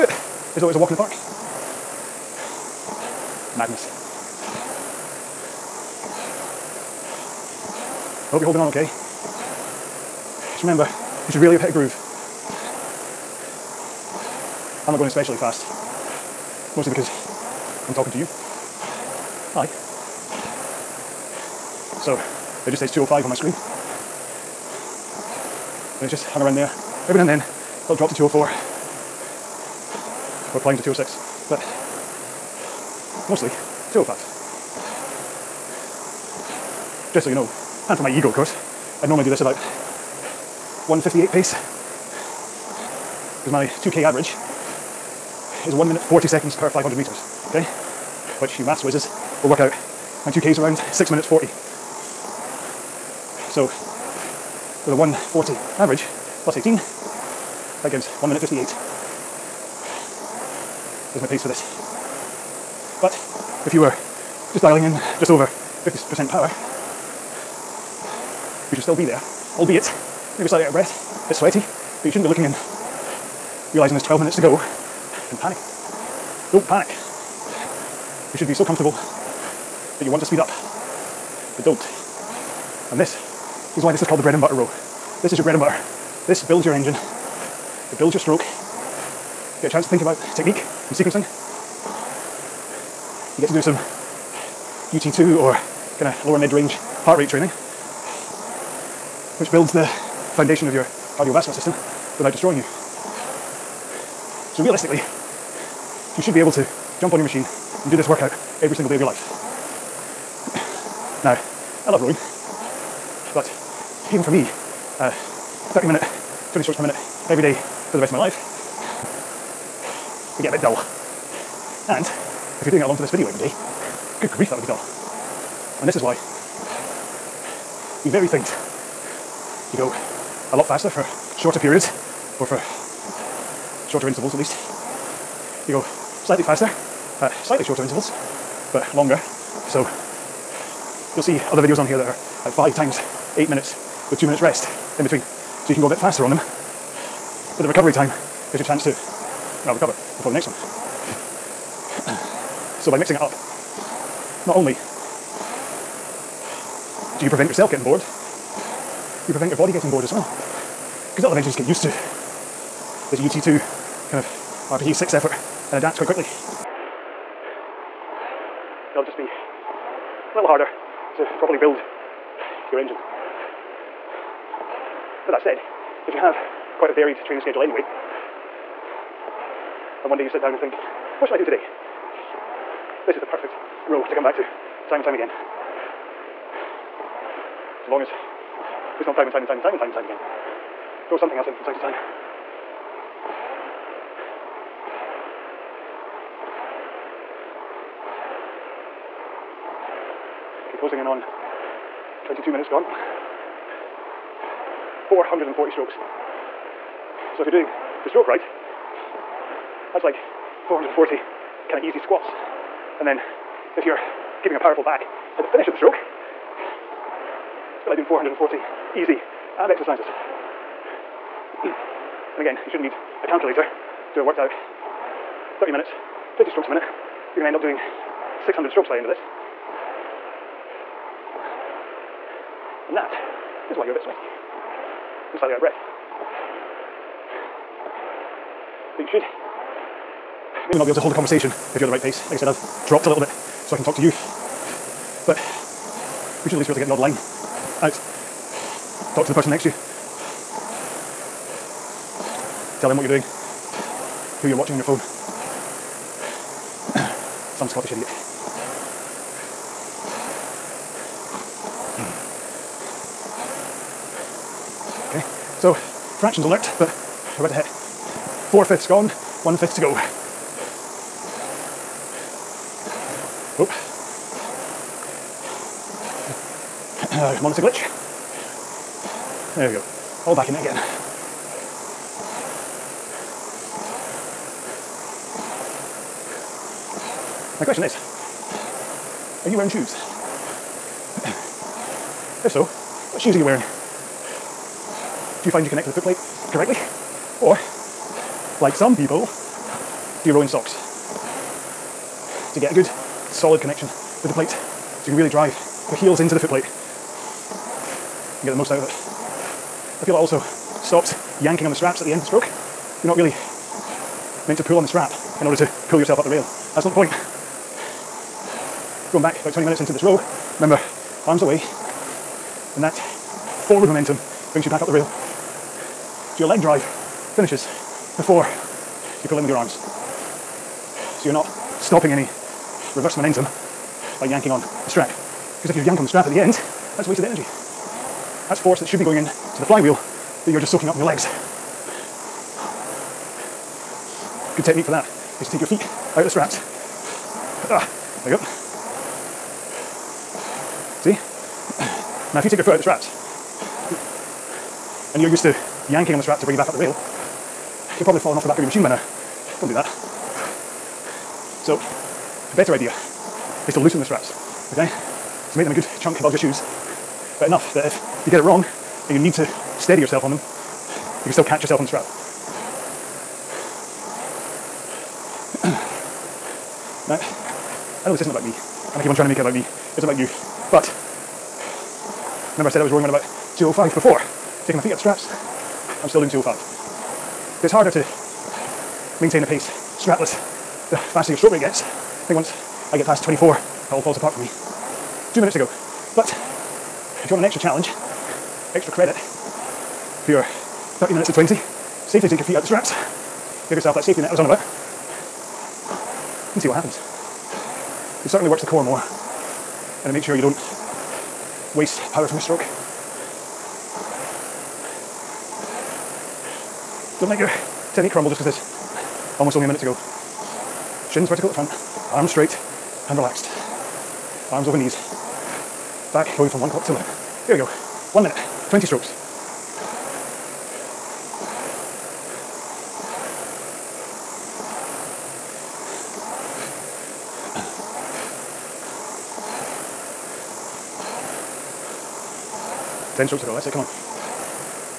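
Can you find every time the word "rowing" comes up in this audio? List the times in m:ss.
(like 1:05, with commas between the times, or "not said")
1:52, 6:22.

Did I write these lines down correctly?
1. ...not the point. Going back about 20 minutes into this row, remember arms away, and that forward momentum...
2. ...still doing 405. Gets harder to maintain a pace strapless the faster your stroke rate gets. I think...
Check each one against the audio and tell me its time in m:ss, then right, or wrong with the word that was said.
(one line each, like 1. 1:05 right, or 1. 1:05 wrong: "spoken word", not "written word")
1. 5:16 right
2. 6:26 wrong: "205", not "405".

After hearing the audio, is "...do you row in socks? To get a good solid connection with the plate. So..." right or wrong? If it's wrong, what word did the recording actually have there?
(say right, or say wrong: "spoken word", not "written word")
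right.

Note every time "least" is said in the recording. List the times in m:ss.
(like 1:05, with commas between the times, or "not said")
2:14, 4:06.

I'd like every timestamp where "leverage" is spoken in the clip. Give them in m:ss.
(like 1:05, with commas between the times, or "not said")
not said.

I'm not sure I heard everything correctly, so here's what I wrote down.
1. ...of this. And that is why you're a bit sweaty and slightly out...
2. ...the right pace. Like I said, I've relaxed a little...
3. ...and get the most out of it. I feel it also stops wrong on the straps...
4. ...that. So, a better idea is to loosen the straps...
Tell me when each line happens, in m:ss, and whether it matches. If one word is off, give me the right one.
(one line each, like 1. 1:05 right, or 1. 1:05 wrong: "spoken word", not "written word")
1. 3:49 right
2. 4:01 wrong: "dropped", not "relaxed"
3. 5:08 wrong: "yanking", not "wrong"
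4. 5:59 right.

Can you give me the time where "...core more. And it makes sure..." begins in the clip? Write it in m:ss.
6:48.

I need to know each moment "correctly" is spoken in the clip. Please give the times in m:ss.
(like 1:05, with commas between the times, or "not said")
4:56.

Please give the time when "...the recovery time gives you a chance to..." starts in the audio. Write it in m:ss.
2:27.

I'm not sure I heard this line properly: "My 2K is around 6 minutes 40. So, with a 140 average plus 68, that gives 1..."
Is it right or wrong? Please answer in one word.
wrong.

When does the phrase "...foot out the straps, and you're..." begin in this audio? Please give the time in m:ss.
5:52.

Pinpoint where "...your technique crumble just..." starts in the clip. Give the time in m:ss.
6:57.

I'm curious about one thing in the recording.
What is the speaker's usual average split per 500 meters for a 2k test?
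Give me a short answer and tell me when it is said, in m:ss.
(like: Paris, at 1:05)
1 minute 40 seconds, at 0:45.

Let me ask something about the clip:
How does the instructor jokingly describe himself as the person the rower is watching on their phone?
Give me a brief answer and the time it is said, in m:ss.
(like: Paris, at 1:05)
Some Scottish idiot, at 4:17.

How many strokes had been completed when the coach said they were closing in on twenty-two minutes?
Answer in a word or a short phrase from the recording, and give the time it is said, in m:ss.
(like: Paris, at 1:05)
440, at 3:25.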